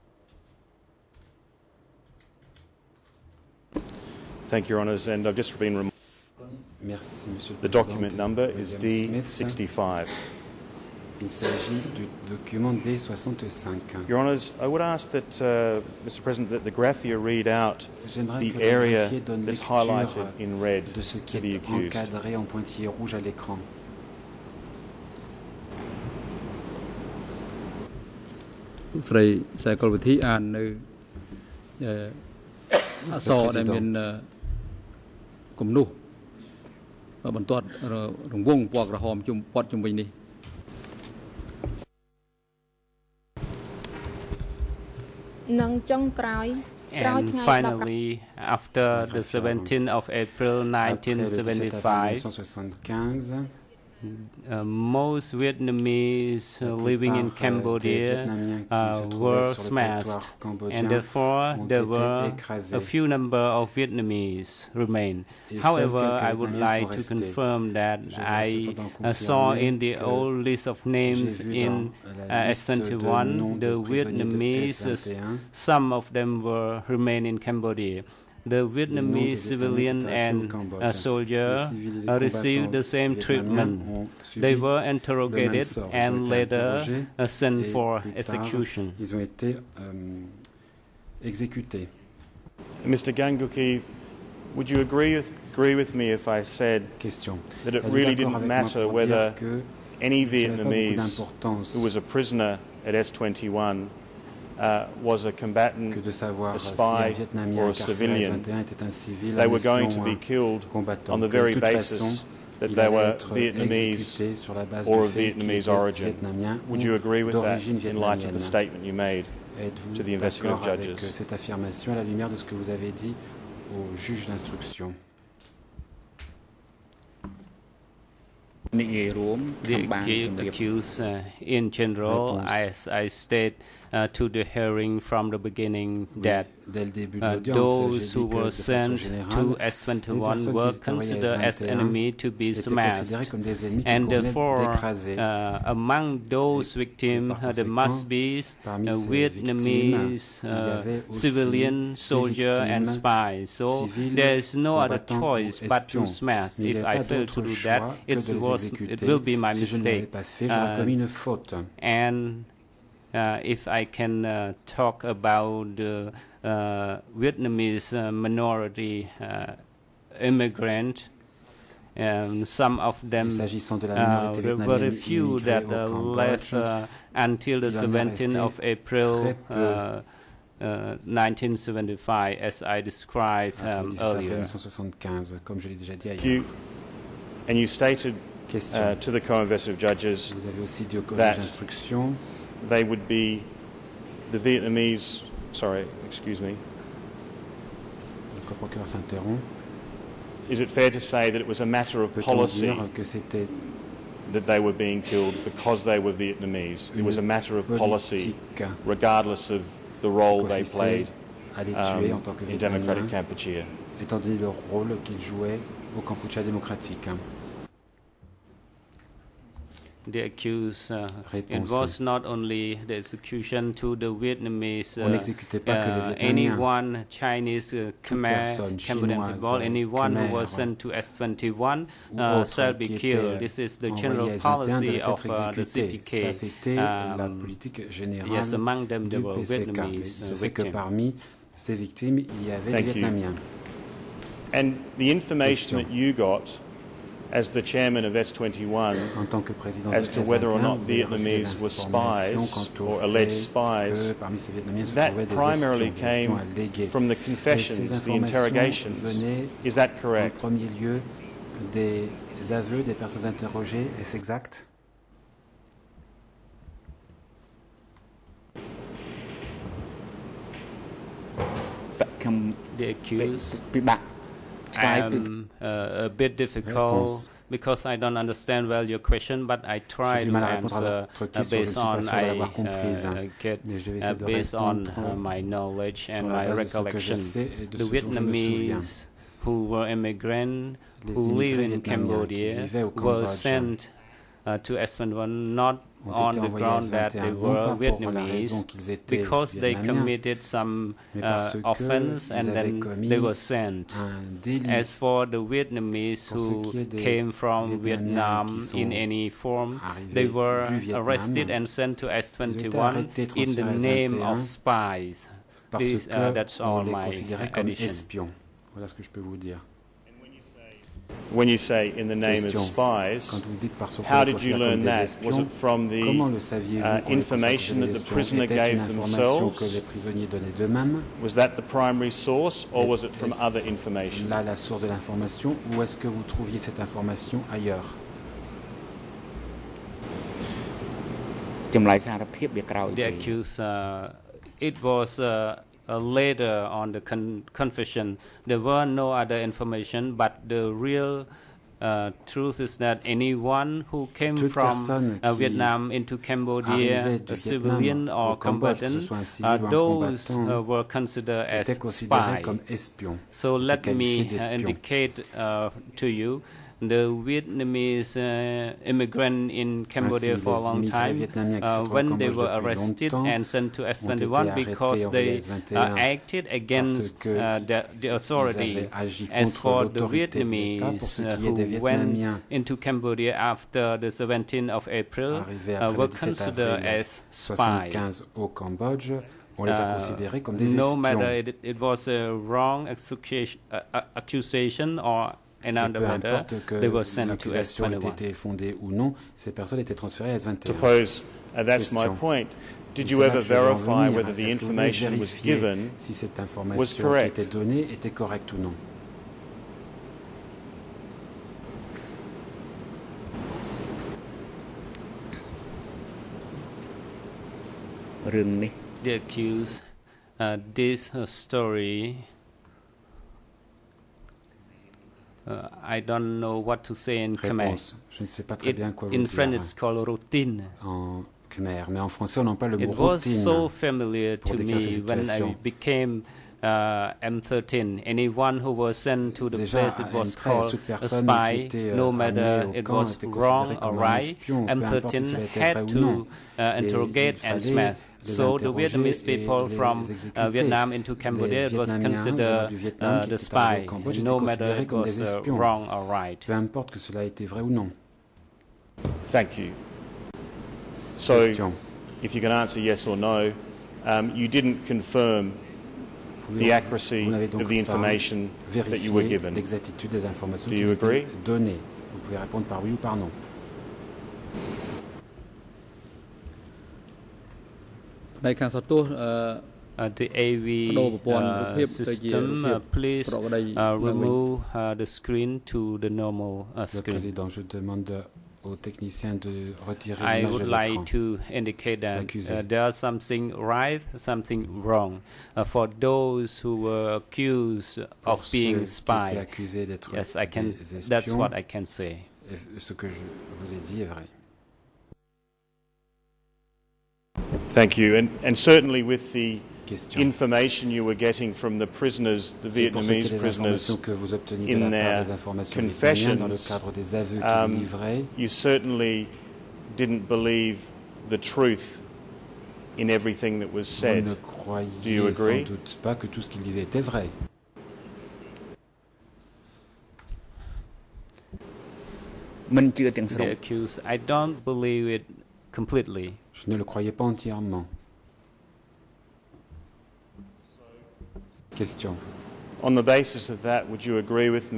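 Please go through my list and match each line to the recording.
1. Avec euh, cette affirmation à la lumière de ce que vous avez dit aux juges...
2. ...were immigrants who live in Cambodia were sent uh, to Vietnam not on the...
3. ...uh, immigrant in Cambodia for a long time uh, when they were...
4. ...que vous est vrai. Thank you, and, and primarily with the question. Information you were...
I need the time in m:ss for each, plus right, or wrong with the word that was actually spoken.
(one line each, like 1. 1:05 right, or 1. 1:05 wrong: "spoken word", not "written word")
1. 2:00 right
2. 4:49 wrong: "Espanol", not "Vietnam"
3. 6:08 right
4. 8:22 wrong: "certainly", not "primarily".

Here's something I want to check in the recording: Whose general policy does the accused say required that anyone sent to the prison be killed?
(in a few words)
the CPK.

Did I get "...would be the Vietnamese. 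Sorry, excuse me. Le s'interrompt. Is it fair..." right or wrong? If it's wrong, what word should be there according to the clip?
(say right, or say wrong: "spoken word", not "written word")
right.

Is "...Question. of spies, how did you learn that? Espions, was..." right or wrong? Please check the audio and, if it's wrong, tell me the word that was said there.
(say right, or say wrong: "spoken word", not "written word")
right.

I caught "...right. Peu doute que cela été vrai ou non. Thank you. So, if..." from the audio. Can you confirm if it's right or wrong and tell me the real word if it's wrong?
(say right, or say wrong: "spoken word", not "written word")
wrong: "importe", not "doute".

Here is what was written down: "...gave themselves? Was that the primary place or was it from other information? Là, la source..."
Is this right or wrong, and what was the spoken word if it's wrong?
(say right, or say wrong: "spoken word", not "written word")
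wrong: "source", not "place".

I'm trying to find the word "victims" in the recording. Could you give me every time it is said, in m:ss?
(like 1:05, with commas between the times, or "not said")
2:26, 4:00.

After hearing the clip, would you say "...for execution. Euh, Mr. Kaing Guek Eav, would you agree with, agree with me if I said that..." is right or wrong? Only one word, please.
right.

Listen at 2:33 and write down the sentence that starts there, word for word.
So there is no other choice but to smash.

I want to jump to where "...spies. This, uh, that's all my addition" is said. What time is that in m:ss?
5:14.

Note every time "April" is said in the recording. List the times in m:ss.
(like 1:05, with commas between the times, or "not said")
0:50, 2:58, 6:24.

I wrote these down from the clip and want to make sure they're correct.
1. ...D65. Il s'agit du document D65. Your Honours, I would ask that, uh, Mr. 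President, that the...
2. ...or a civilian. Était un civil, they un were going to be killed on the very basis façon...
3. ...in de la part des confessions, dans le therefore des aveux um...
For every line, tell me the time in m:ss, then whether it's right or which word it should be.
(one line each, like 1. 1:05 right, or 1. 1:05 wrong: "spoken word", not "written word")
1. 0:08 right
2. 1:47 right
3. 8:34 wrong: "cadre", not "therefore".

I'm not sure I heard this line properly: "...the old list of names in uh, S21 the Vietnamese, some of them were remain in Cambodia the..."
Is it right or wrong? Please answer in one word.
right.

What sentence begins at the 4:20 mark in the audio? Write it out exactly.
En premier lieu, des aveux des personnes interrogées, est-ce exact?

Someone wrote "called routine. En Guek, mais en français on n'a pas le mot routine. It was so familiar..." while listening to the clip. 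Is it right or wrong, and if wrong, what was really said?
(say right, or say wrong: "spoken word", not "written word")
wrong: "Khmer", not "Guek".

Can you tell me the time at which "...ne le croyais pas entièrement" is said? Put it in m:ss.
8:56.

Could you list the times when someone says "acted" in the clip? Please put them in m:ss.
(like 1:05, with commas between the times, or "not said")
6:15.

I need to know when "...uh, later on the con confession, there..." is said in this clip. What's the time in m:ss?
5:45.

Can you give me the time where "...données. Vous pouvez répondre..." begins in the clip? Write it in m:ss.
7:51.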